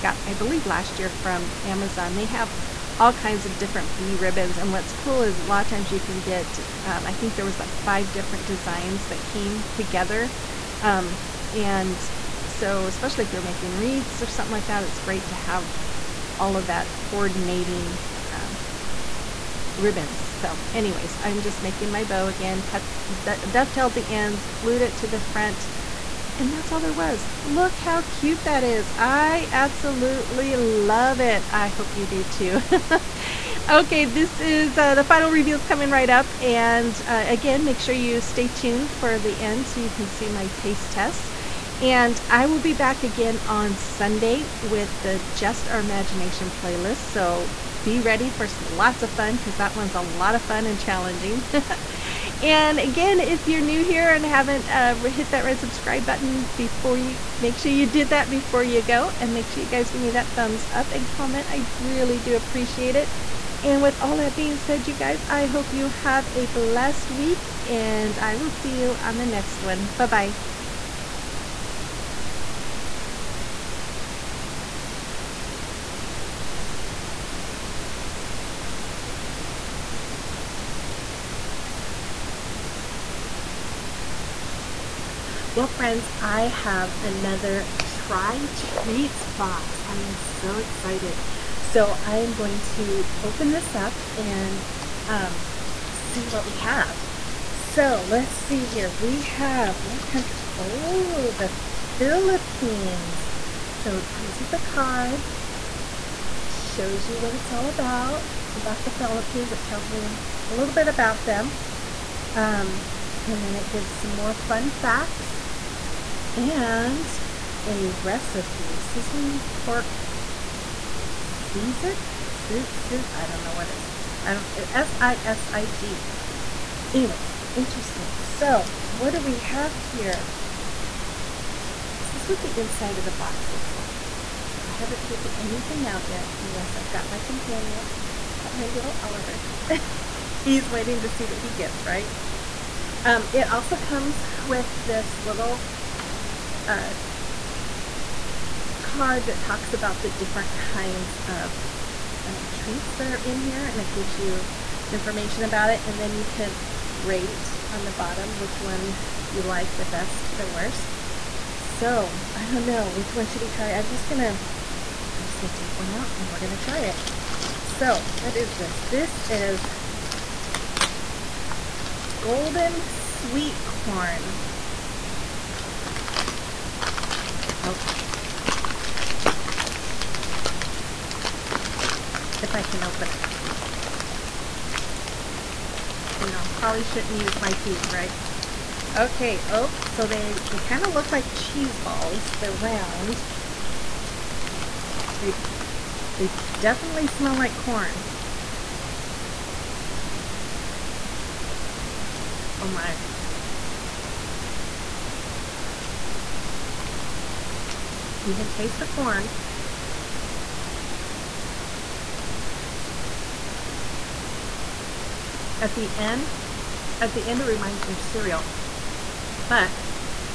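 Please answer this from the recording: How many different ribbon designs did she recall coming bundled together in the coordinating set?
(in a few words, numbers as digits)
5.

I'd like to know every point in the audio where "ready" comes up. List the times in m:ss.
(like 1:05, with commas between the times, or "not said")
0:47.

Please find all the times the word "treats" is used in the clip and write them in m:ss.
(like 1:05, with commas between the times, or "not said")
1:28, 2:32.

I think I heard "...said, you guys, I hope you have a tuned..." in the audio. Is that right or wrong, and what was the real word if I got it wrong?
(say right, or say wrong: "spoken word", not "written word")
wrong: "blessed", not "tuned".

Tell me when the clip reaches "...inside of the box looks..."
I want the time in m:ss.
2:12.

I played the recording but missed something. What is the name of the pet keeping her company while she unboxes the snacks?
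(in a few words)
Oliver.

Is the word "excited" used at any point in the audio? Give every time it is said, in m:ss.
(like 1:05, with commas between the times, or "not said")
1:30.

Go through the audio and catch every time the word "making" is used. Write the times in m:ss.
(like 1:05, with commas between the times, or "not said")
0:13, 0:21.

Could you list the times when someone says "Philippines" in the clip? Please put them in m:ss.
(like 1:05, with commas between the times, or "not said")
1:41, 1:48.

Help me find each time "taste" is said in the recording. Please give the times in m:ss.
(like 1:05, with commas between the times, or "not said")
0:40, 3:28.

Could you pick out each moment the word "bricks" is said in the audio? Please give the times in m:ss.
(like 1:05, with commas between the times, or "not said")
not said.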